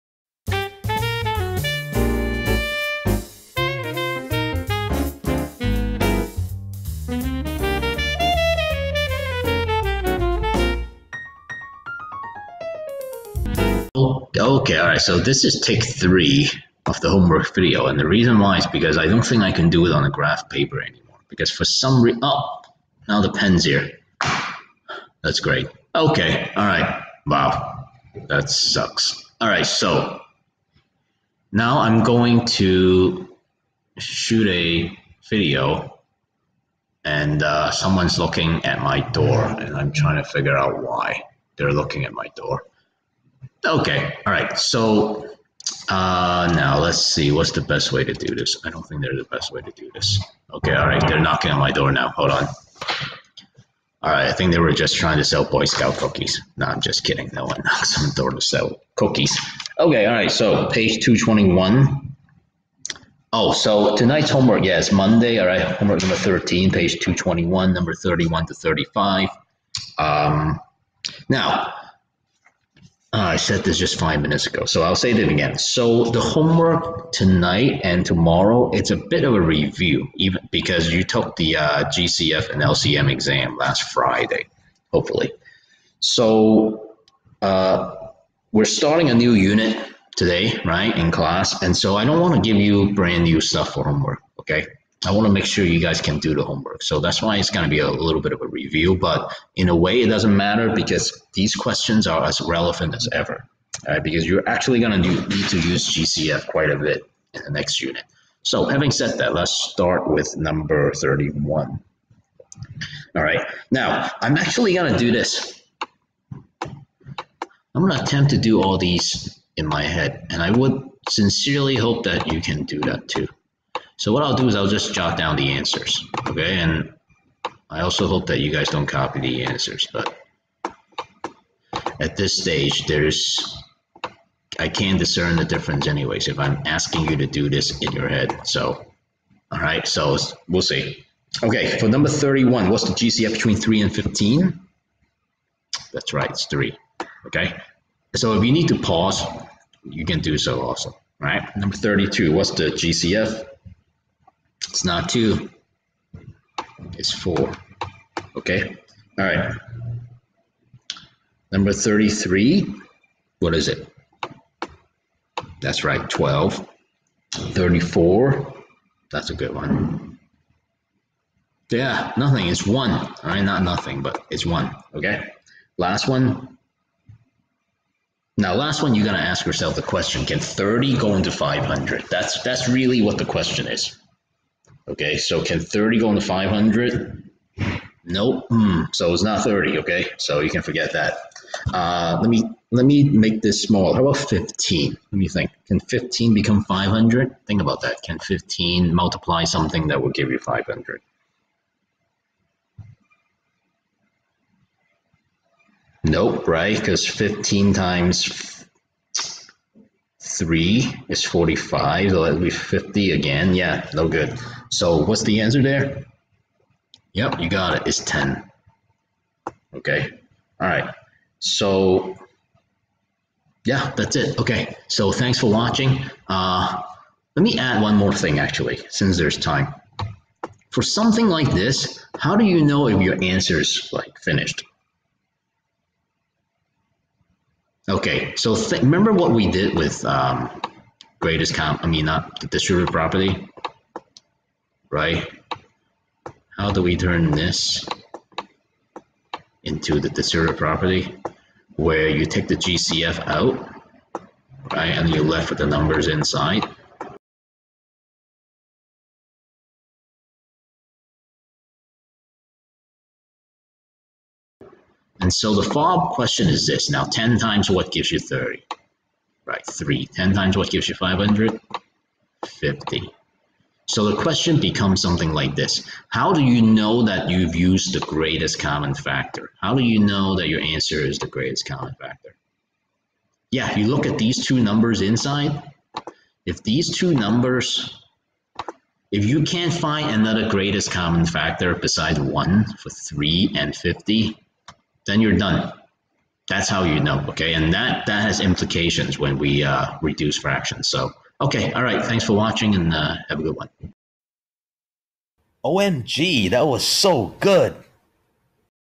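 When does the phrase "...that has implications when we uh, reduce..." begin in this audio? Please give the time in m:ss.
4:58.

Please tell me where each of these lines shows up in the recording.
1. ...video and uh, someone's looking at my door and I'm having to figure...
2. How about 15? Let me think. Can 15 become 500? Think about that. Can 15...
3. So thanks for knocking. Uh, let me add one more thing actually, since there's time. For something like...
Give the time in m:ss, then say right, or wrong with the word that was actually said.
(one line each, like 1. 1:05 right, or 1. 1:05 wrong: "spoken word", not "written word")
1. 0:35 wrong: "trying", not "having"
2. 3:13 right
3. 3:44 wrong: "watching", not "knocking".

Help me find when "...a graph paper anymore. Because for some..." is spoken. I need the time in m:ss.
0:20.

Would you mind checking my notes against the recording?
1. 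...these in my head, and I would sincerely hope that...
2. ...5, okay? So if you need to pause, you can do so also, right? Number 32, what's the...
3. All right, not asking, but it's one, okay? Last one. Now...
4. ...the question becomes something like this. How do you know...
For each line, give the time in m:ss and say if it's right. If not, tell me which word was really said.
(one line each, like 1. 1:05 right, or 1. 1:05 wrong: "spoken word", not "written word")
1. 1:58 right
2. 2:26 wrong: "3", not "5"
3. 2:52 wrong: "nothing", not "asking"
4. 4:34 right.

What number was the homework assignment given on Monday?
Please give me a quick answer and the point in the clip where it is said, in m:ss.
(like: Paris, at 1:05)
13, at 1:05.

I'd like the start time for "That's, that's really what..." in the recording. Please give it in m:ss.
3:02.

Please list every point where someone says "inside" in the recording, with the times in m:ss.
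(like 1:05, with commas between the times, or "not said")
4:16, 4:45.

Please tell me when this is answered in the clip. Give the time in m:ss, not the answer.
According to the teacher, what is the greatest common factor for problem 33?
2:46.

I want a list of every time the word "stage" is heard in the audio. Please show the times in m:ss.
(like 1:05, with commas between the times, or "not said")
2:12.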